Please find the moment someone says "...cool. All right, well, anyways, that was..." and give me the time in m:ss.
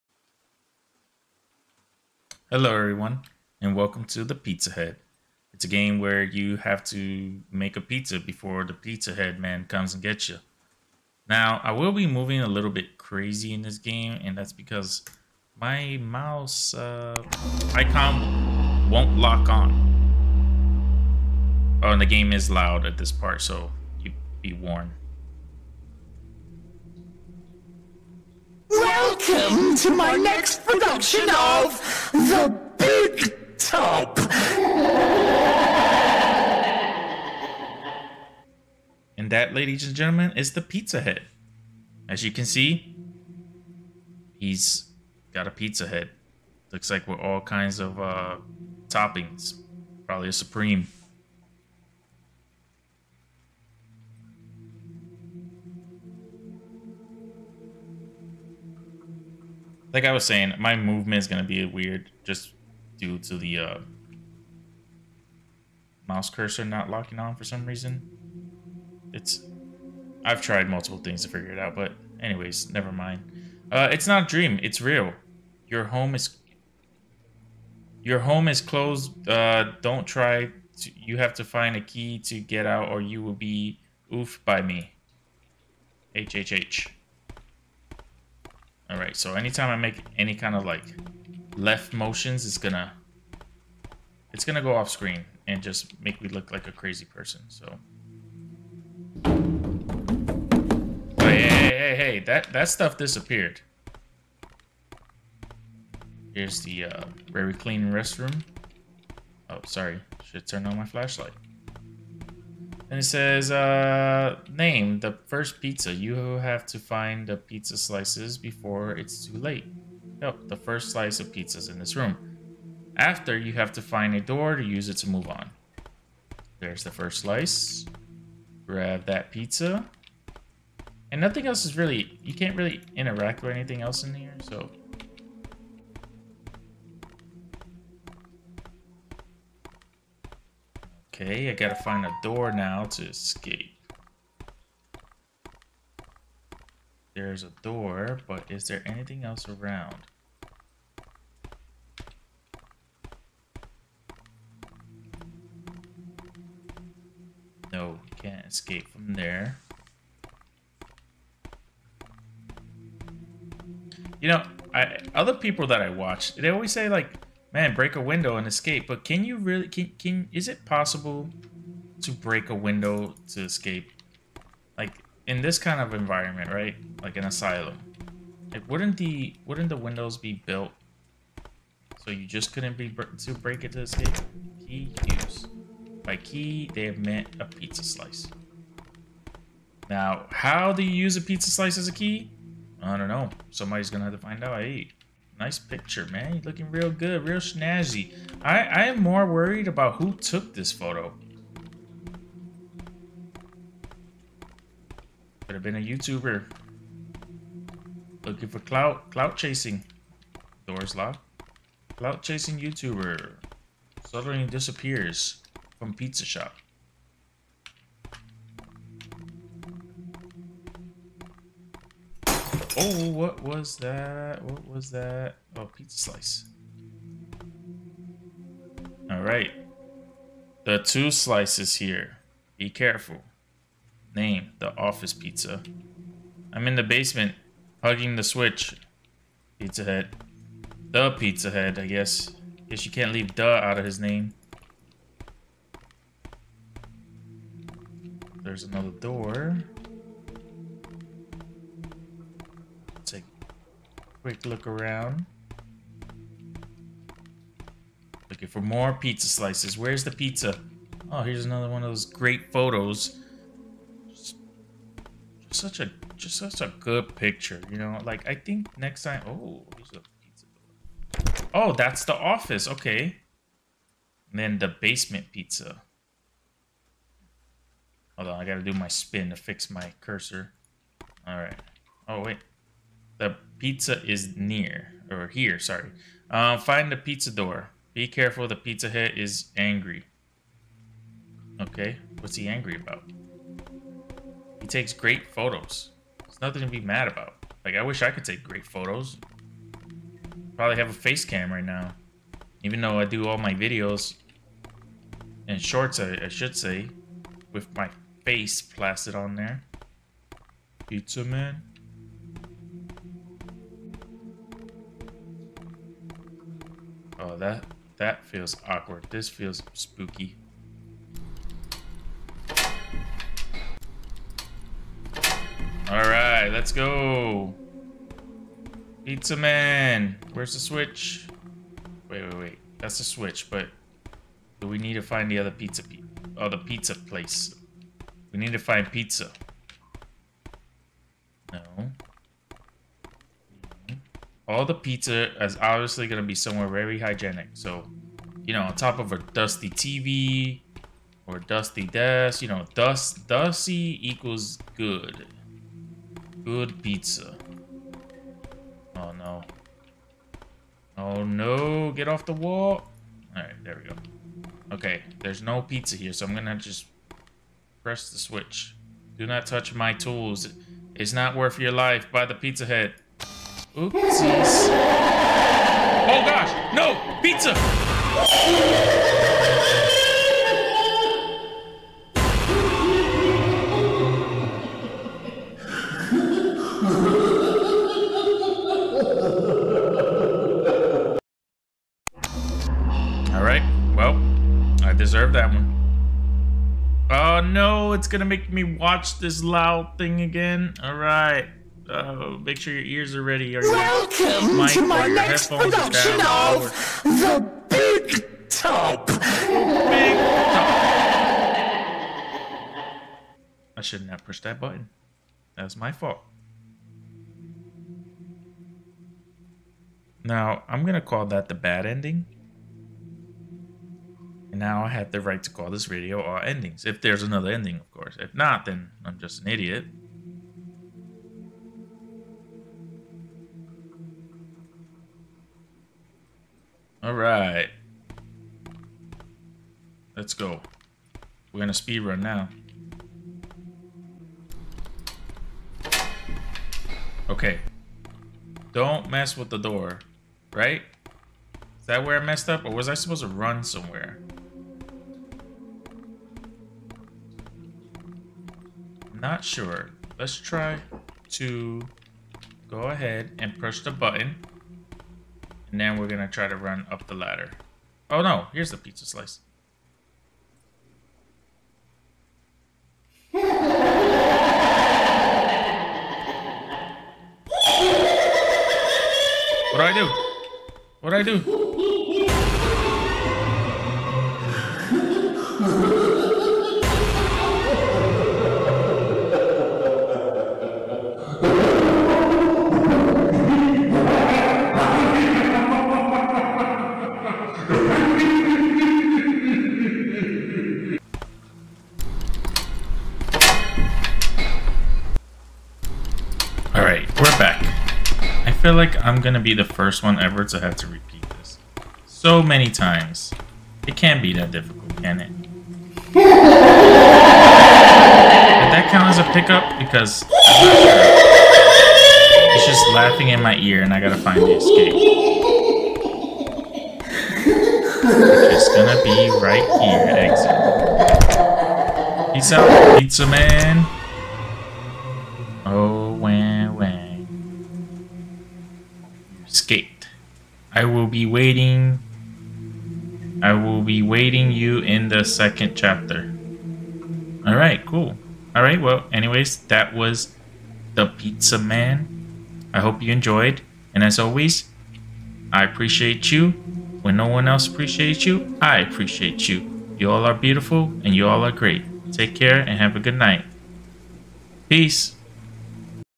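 9:07.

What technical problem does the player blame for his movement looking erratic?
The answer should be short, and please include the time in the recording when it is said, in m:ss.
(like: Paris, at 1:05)
Mouse cursor not locking, at 1:06.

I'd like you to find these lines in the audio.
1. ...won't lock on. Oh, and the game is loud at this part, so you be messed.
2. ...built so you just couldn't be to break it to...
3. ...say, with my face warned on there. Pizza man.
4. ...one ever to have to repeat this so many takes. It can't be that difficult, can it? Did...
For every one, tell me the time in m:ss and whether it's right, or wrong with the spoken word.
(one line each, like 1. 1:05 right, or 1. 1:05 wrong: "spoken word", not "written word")
1. 0:18 wrong: "warned", not "messed"
2. 3:00 right
3. 5:06 wrong: "plastered", not "warned"
4. 8:30 wrong: "times", not "takes".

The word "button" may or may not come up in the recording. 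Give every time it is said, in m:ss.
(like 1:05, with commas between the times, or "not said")
6:54, 7:43.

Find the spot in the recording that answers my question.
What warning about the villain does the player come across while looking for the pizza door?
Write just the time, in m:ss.
4:48.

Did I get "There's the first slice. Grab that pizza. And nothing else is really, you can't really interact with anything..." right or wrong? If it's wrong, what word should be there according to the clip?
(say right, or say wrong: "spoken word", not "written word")
right.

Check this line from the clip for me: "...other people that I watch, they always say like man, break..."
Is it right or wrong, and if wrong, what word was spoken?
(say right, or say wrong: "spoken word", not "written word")
right.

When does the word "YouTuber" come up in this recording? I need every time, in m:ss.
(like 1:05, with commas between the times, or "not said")
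3:25, 3:32.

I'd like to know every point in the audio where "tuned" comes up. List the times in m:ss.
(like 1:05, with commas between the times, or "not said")
not said.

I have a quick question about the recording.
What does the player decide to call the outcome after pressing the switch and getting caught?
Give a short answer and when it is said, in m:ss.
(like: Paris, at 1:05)
The bad ending, at 7:01.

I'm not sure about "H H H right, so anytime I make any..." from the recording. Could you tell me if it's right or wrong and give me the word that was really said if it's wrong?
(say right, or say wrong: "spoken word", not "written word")
right.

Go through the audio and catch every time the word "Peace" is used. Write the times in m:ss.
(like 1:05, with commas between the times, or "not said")
8:52, 9:24.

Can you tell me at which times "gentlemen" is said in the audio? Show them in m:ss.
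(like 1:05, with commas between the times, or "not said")
0:39.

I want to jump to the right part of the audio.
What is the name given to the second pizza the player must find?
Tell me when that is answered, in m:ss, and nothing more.
3:54.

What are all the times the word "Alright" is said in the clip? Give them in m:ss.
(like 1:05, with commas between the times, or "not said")
4:41, 6:33, 6:40, 7:17.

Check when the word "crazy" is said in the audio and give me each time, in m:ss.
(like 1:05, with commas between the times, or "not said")
0:12, 1:36.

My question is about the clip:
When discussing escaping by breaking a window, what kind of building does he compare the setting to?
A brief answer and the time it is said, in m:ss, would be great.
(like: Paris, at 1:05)
An asylum, at 2:57.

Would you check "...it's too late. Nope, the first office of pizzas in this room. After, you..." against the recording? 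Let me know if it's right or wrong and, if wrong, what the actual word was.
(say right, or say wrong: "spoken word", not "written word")
wrong: "slice", not "office".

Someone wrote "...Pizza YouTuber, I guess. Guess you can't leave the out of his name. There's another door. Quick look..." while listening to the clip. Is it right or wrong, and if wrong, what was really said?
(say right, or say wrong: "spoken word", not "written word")
wrong: "Head", not "YouTuber".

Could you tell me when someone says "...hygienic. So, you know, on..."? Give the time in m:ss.
5:46.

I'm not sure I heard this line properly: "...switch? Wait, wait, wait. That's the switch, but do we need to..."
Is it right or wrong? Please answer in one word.
right.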